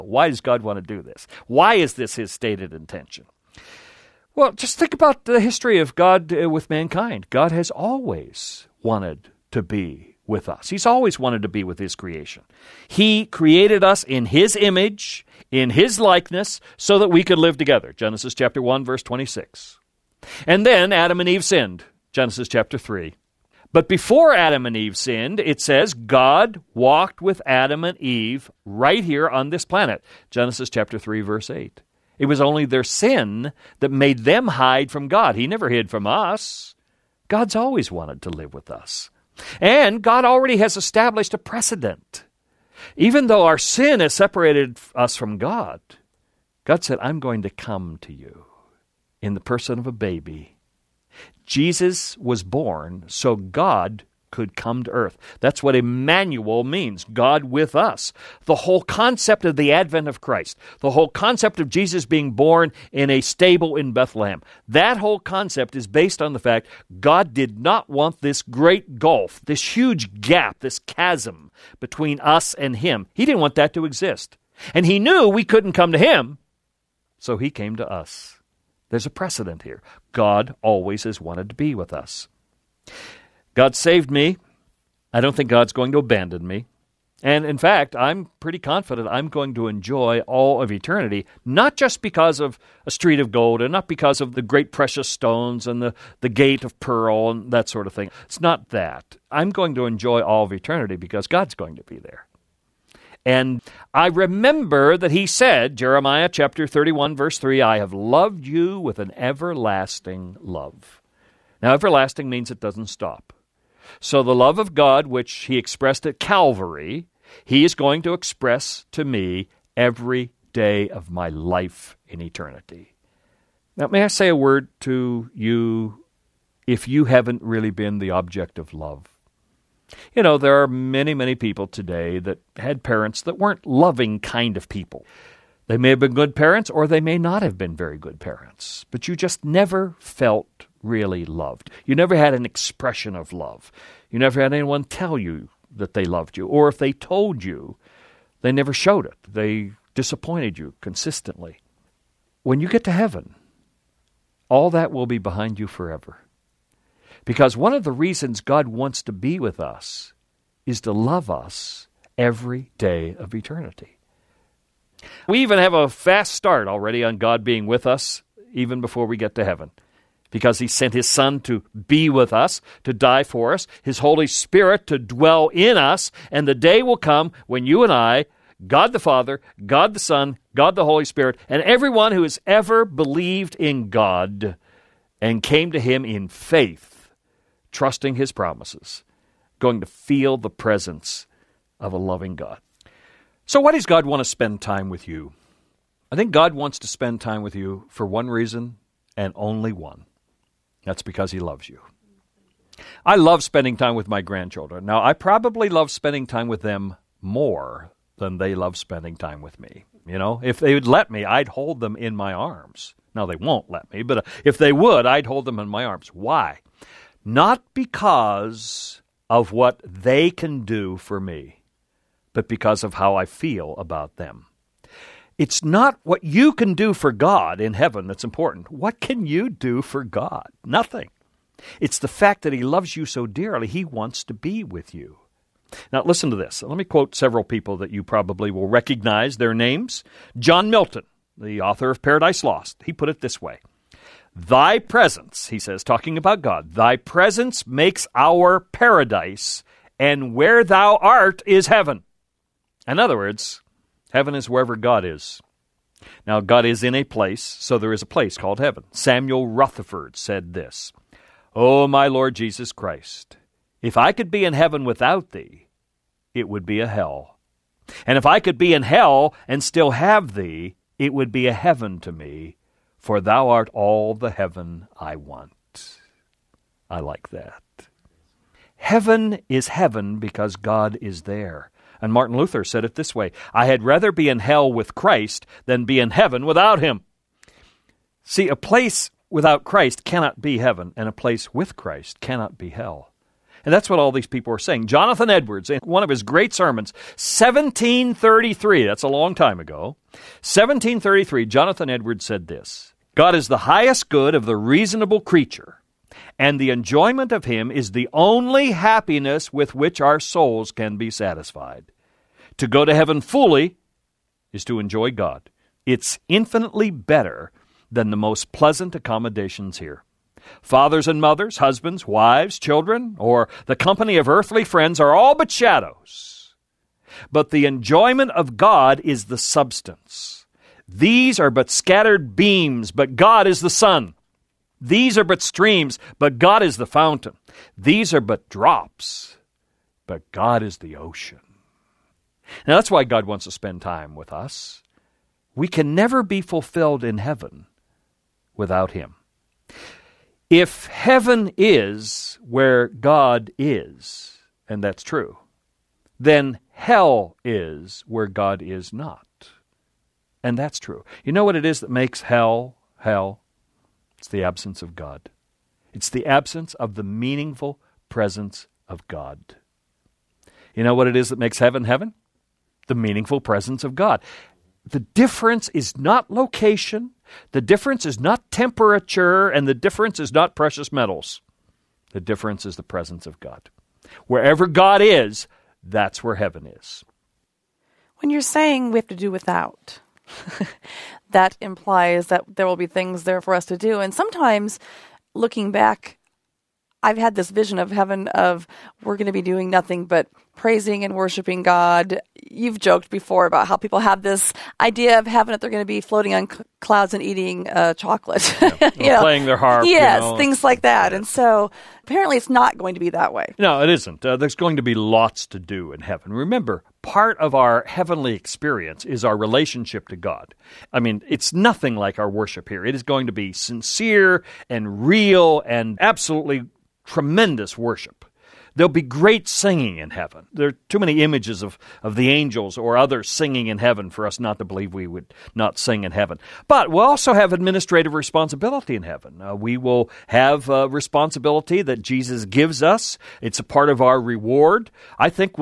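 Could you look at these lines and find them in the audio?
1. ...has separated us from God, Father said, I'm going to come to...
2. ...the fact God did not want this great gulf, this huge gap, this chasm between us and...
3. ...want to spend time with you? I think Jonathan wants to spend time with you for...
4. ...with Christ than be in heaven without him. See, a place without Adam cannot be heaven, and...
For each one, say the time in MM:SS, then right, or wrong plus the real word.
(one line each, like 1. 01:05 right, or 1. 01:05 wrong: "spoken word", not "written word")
1. 00:43 wrong: "God", not "Father"
2. 01:06 right
3. 03:14 wrong: "God", not "Jonathan"
4. 04:44 wrong: "Christ", not "Adam".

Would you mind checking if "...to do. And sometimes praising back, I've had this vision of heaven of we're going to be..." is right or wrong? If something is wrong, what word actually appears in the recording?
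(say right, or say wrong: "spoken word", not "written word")
wrong: "looking", not "praising".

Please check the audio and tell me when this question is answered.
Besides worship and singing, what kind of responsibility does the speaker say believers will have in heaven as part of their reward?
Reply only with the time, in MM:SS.
07:17.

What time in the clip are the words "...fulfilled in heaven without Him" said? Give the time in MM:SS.
05:46.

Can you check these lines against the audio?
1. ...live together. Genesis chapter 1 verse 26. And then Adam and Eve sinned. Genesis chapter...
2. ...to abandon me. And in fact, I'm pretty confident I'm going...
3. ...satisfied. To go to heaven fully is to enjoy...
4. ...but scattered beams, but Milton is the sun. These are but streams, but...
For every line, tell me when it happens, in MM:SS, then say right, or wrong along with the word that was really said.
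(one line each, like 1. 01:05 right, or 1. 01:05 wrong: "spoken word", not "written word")
1. 00:17 right
2. 01:25 right
3. 05:11 right
4. 05:31 wrong: "God", not "Milton".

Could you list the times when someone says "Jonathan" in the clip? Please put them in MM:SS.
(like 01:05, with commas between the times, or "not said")
04:54, 05:01.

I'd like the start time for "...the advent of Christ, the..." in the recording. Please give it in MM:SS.
00:59.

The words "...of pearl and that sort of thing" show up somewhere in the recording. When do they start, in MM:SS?
01:36.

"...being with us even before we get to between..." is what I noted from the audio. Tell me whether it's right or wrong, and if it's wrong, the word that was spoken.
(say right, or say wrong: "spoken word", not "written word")
wrong: "heaven", not "between".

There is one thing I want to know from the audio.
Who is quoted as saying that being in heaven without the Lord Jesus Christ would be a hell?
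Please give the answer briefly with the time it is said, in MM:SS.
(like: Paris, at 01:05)
Samuel Rutherford, at 04:18.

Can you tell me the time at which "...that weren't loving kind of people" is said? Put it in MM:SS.
02:13.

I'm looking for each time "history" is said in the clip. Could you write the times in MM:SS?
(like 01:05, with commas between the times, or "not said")
00:05.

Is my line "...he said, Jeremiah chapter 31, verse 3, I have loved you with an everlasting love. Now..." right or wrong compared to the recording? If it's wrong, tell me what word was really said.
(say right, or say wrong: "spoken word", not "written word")
right.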